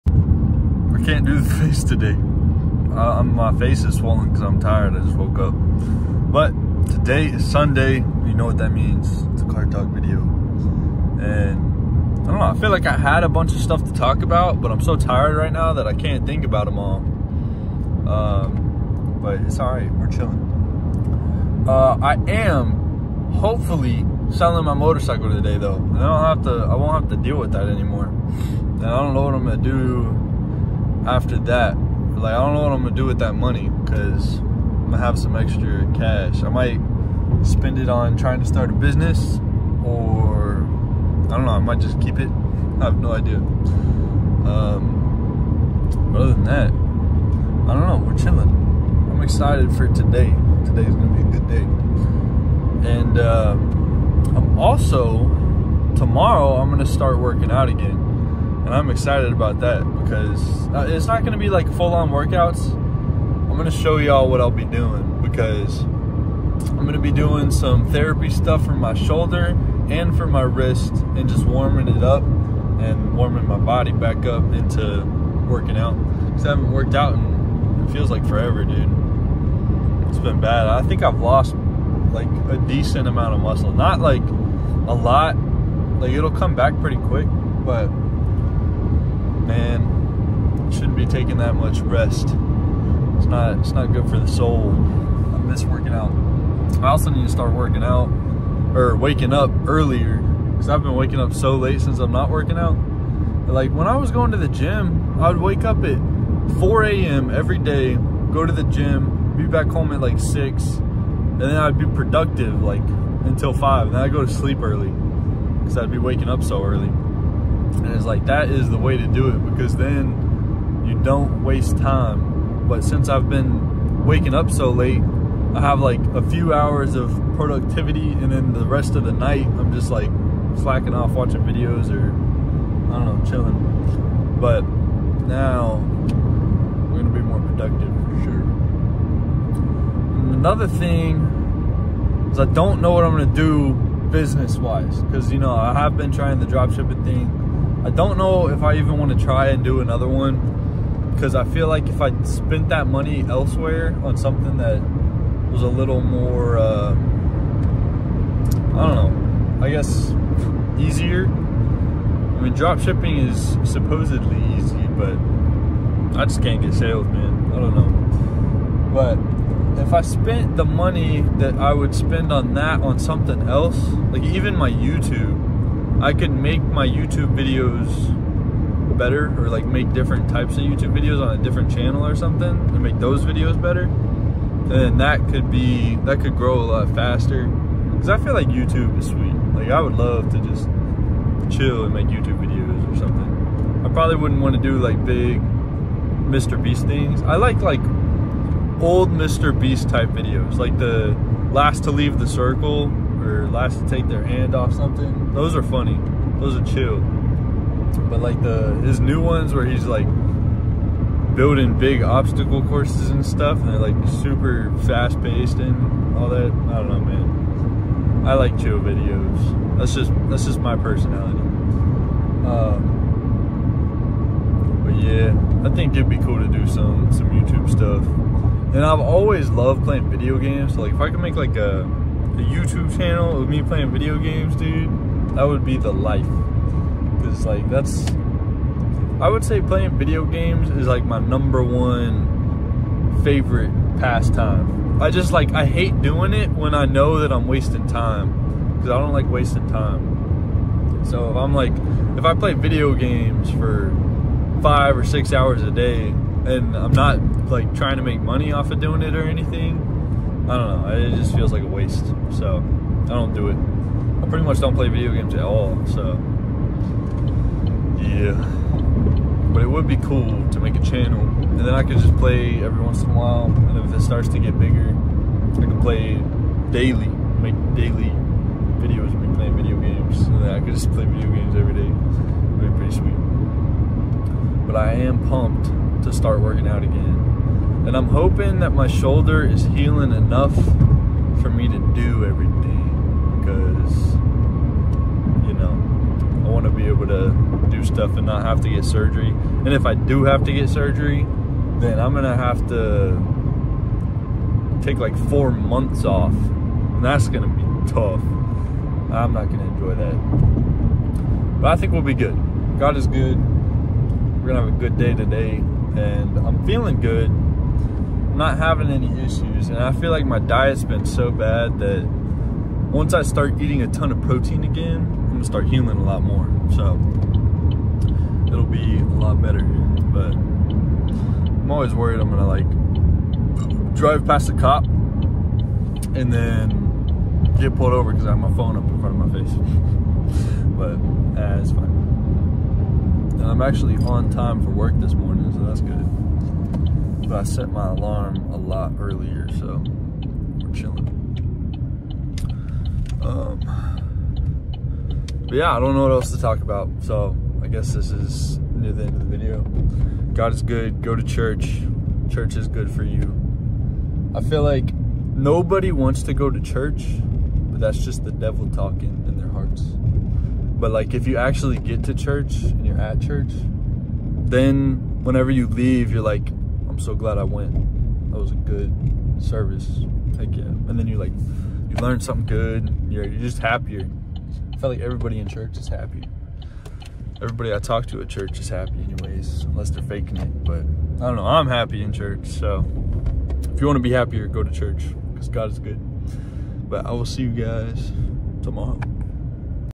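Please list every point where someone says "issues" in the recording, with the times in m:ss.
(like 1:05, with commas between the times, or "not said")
5:19.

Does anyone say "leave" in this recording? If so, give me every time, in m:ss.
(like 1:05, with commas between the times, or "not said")
3:21, 6:15.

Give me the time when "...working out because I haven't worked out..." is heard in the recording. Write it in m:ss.
1:15.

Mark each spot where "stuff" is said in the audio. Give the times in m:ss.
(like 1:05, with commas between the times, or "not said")
0:13, 1:08, 3:33, 3:47, 4:57.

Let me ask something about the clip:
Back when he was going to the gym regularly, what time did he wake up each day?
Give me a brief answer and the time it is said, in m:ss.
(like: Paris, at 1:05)
4 a.m., at 1:46.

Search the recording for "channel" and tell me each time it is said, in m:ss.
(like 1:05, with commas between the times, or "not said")
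3:01, 3:52, 4:30.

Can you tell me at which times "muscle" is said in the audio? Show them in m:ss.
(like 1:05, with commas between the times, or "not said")
1:23.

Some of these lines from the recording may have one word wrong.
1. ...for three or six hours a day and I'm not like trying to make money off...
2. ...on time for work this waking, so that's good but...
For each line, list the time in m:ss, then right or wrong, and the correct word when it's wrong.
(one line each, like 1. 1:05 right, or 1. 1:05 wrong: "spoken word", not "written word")
1. 4:13 wrong: "five", not "three"
2. 5:44 wrong: "morning", not "waking".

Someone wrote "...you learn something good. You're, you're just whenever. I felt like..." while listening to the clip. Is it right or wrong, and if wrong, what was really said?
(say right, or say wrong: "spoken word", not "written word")
wrong: "happier", not "whenever".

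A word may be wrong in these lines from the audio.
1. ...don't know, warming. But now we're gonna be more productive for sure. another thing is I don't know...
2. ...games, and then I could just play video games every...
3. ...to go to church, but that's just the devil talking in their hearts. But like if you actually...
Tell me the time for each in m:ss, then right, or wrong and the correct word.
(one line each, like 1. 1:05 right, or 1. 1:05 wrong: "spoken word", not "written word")
1. 2:13 wrong: "chilling", not "warming"
2. 4:39 right
3. 6:06 right.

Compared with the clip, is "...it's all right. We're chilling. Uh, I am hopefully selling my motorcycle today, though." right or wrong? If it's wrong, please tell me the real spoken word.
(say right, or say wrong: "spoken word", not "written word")
right.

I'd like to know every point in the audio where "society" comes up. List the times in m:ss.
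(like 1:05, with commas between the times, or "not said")
not said.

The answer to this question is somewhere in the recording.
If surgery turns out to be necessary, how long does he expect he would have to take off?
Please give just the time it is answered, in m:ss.
5:05.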